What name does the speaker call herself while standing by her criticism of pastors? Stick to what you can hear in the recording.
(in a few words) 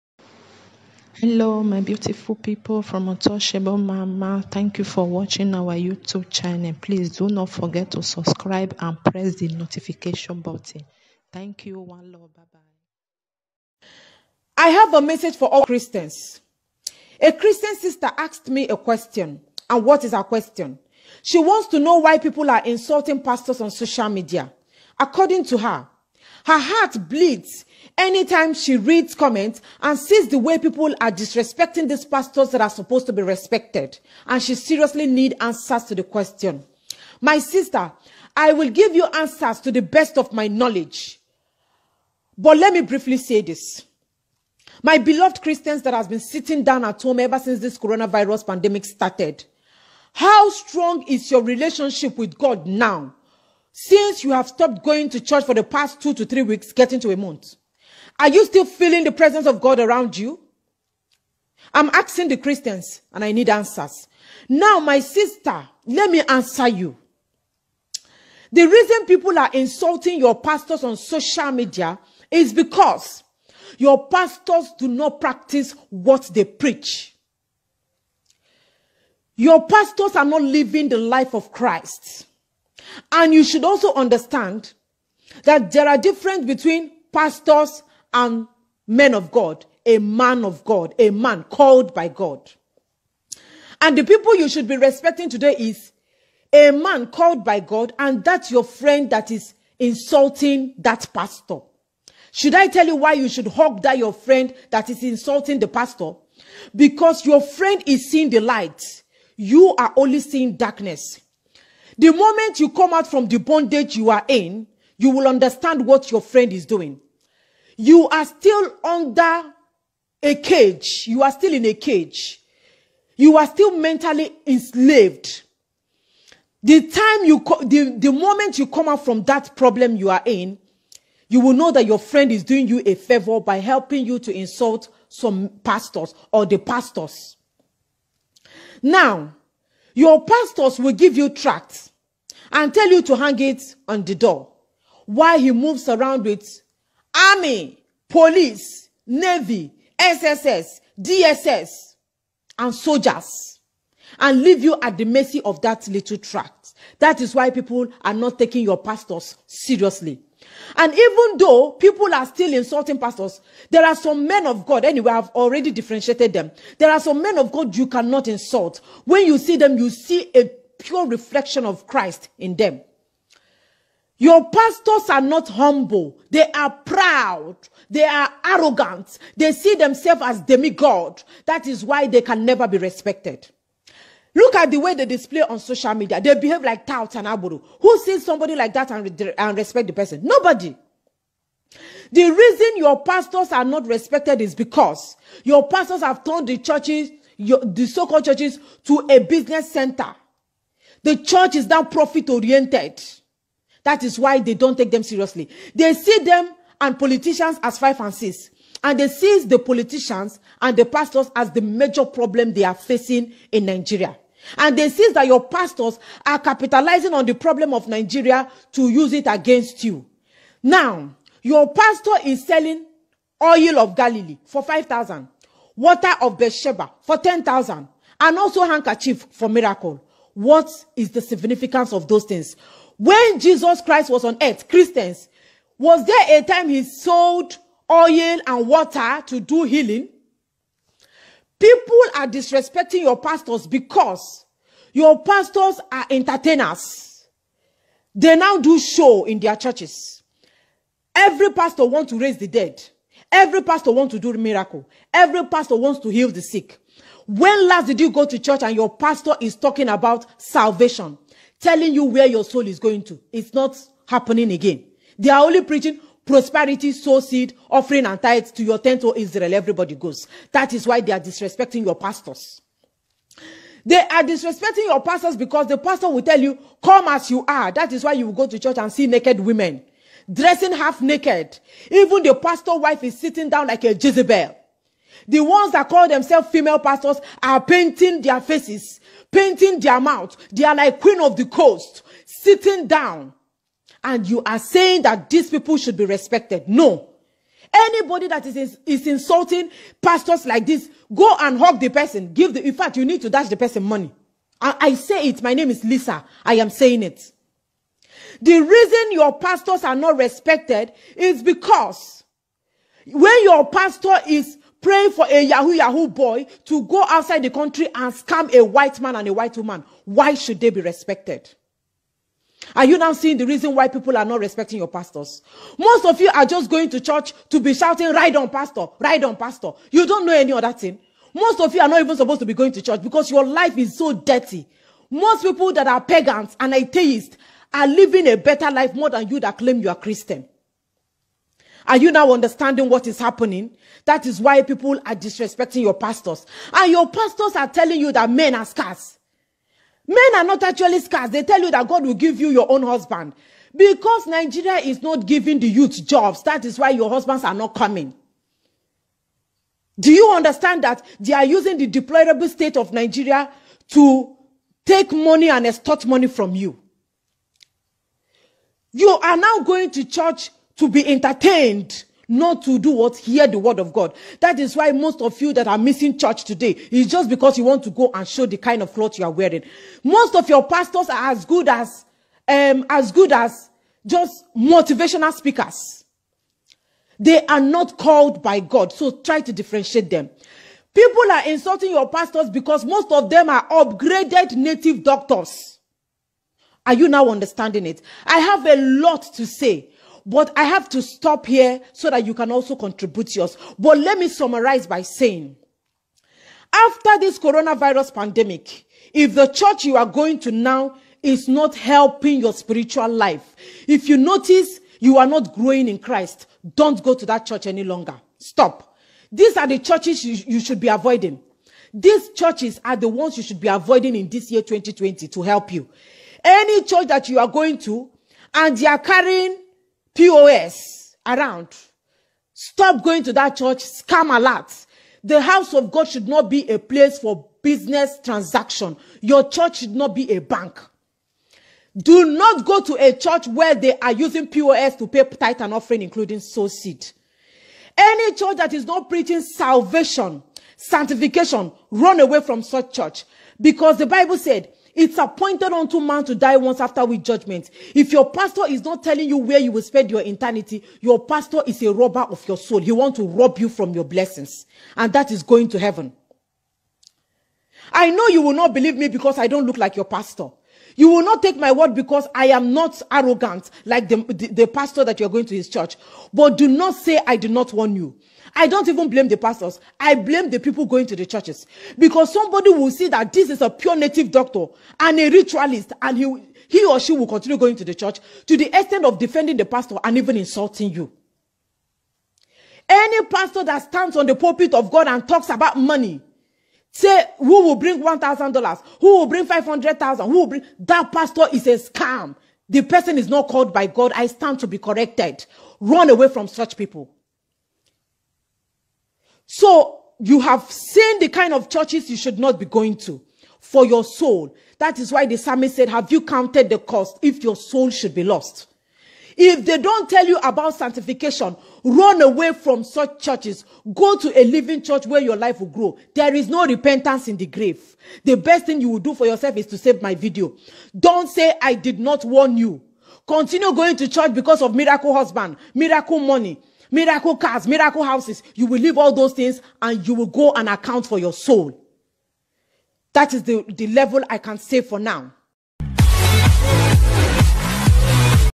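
Lisa.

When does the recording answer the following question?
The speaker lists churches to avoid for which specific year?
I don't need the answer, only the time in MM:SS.
07:04.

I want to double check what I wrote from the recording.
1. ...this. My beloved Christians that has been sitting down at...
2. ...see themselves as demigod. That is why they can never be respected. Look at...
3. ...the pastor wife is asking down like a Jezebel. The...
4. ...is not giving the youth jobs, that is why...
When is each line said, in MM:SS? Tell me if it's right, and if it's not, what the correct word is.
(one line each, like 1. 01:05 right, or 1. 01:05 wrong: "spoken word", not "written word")
1. 00:43 right
2. 02:59 right
3. 04:42 wrong: "sitting", not "asking"
4. 05:54 right.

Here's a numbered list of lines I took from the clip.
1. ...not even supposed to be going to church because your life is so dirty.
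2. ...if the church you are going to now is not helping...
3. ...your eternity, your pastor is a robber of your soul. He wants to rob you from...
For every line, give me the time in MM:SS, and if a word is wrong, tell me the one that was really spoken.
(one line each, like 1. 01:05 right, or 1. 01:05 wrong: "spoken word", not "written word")
1. 05:31 right
2. 06:49 right
3. 07:40 right.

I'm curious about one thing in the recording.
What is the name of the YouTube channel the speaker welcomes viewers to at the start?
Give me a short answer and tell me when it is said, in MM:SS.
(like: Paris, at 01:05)
Untouchable Mama, at 00:03.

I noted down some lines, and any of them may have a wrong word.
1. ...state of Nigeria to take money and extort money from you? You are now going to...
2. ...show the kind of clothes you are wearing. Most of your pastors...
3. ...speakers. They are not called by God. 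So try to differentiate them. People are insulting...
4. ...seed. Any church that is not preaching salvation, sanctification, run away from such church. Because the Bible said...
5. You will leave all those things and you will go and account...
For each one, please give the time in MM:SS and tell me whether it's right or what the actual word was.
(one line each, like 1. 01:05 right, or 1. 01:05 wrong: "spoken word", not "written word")
1. 06:02 right
2. 06:18 right
3. 06:25 right
4. 07:26 right
5. 08:58 right.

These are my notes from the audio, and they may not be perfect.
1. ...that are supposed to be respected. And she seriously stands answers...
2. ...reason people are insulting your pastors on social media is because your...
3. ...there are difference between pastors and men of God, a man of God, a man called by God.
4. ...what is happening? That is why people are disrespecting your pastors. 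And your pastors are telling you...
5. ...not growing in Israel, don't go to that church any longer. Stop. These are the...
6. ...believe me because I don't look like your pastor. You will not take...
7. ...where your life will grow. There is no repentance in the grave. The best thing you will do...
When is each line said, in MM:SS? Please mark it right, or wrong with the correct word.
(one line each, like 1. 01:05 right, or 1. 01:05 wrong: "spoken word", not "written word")
1. 00:32 wrong: "needs", not "stands"
2. 01:08 right
3. 01:25 right
4. 05:42 right
5. 06:55 wrong: "Christ", not "Israel"
6. 07:48 right
7. 08:45 right.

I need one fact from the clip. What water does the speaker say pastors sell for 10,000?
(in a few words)
Water of Beersheba.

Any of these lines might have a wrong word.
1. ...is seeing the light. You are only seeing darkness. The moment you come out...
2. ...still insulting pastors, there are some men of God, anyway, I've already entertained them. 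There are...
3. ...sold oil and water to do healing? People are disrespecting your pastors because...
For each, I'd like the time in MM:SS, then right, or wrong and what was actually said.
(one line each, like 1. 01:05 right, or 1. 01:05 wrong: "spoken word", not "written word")
1. 01:47 right
2. 02:42 wrong: "differentiated", not "entertained"
3. 03:56 right.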